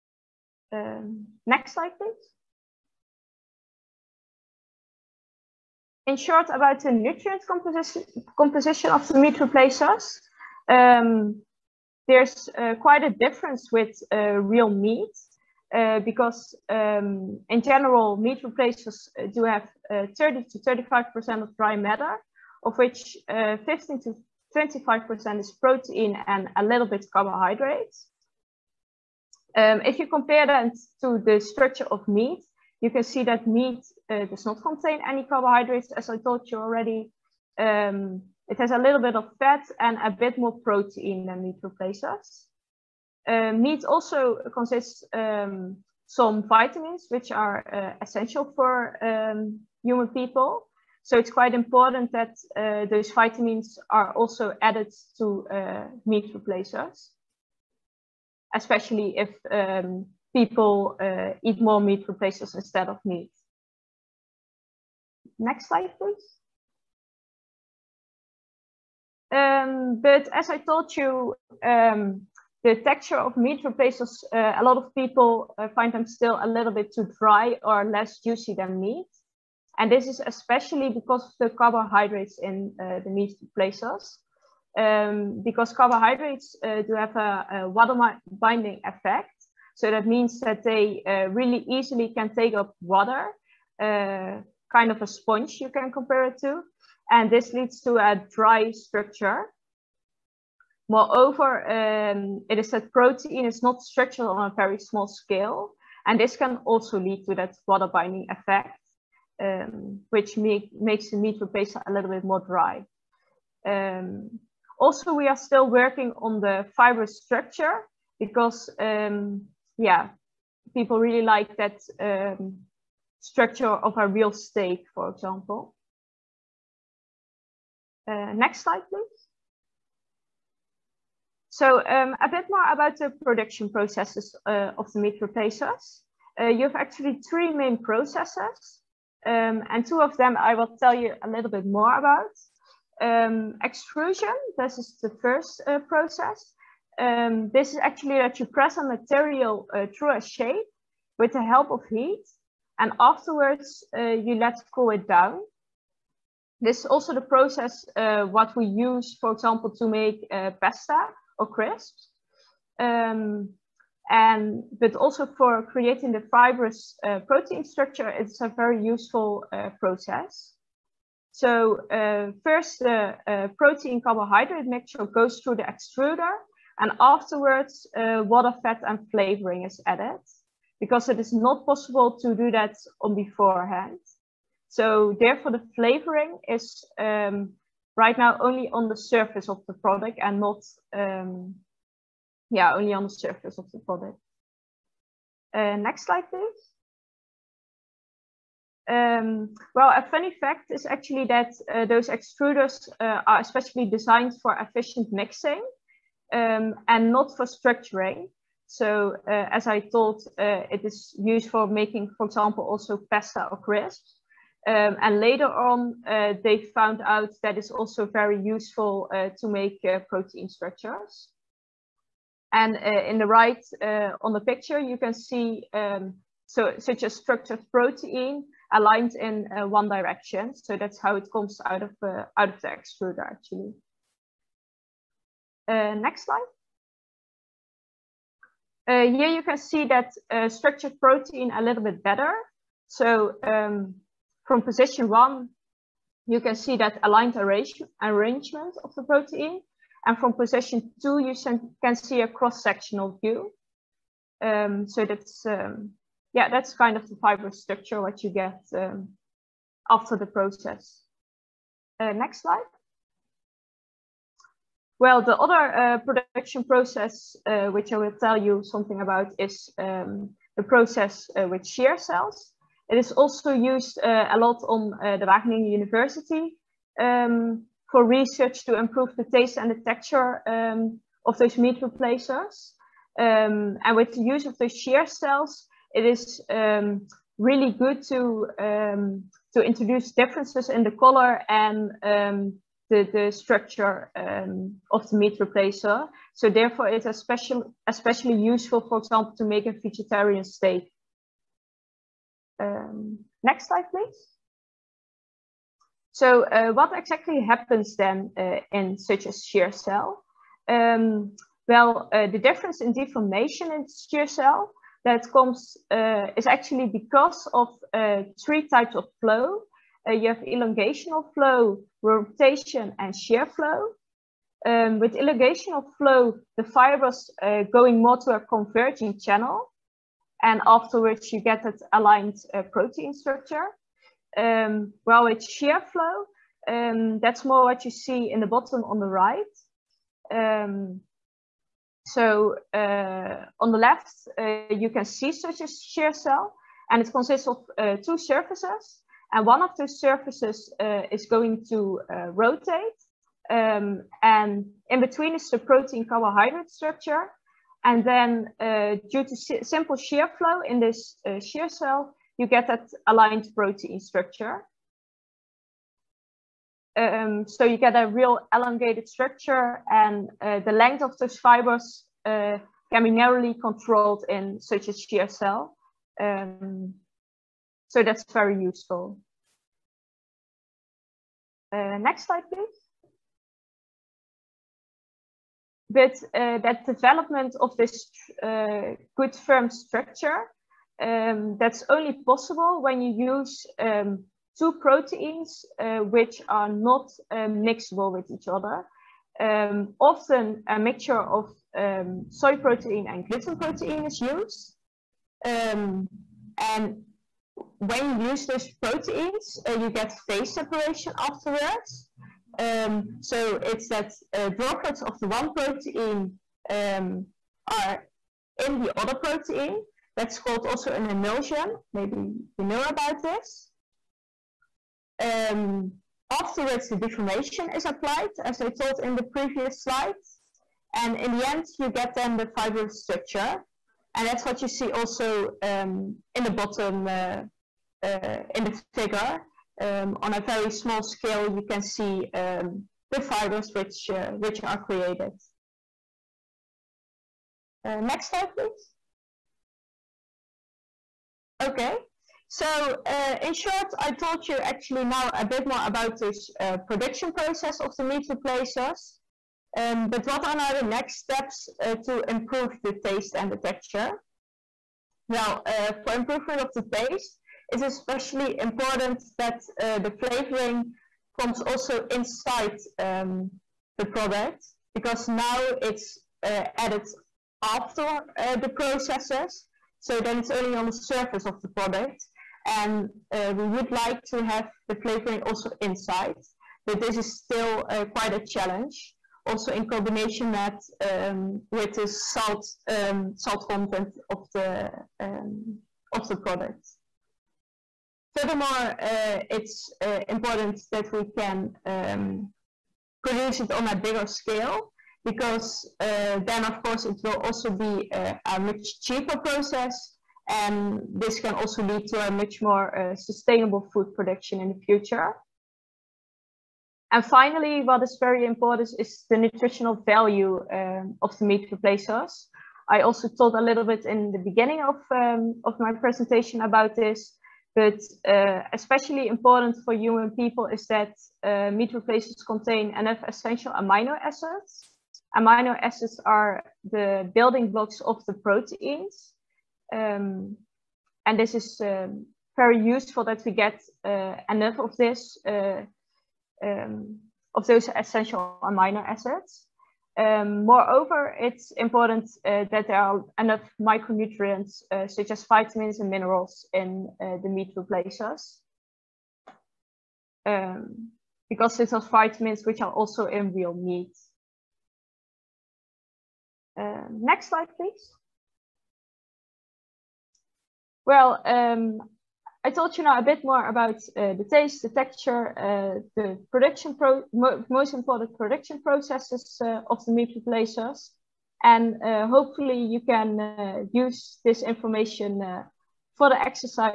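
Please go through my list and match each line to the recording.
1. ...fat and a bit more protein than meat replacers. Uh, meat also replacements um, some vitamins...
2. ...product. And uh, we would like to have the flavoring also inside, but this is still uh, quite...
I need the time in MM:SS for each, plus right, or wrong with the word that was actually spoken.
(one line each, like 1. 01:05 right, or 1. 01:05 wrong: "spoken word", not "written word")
1. 00:39 wrong: "consists", not "replacements"
2. 08:01 right.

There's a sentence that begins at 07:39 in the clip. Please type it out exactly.
Um, but what are now the next steps uh, to improve the taste and the texture?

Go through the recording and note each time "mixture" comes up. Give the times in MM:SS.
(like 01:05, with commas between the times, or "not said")
02:54, 06:40.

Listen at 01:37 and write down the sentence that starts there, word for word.
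And this leads to a dry structure.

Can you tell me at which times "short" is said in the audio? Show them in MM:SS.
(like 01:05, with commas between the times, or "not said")
00:06, 07:33.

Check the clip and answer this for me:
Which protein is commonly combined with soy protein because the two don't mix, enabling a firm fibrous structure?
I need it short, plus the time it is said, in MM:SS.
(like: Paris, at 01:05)
Gluten protein, at 06:43.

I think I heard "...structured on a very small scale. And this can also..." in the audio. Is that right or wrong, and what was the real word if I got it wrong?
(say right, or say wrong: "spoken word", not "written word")
right.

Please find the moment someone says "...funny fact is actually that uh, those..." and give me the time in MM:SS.
03:20.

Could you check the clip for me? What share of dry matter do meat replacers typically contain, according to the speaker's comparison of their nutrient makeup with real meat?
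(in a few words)
30 to 35%.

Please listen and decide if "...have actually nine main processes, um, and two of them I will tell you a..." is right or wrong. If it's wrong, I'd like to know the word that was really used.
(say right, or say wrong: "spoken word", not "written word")
wrong: "three", not "nine".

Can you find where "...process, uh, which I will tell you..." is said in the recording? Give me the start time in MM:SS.
04:26.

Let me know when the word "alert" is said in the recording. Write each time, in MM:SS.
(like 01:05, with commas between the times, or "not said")
not said.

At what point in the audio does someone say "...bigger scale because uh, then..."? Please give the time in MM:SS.
08:23.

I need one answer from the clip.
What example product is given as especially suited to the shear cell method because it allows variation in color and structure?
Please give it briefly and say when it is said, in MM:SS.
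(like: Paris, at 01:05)
Vegetarian steak, at 04:59.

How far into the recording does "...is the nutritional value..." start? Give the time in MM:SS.
08:38.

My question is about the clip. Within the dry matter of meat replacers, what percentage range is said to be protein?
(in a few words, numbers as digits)
15 to 25%.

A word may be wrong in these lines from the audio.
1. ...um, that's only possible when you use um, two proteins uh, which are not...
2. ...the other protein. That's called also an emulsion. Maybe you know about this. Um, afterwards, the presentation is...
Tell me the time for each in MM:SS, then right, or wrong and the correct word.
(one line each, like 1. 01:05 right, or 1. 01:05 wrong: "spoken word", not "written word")
1. 06:31 right
2. 06:58 wrong: "deformation", not "presentation".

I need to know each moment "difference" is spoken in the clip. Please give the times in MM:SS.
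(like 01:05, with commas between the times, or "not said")
00:13, 04:50, 05:12.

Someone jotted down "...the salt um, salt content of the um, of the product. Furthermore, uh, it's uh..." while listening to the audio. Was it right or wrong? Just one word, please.
right.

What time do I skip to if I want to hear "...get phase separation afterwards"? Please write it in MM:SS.
06:49.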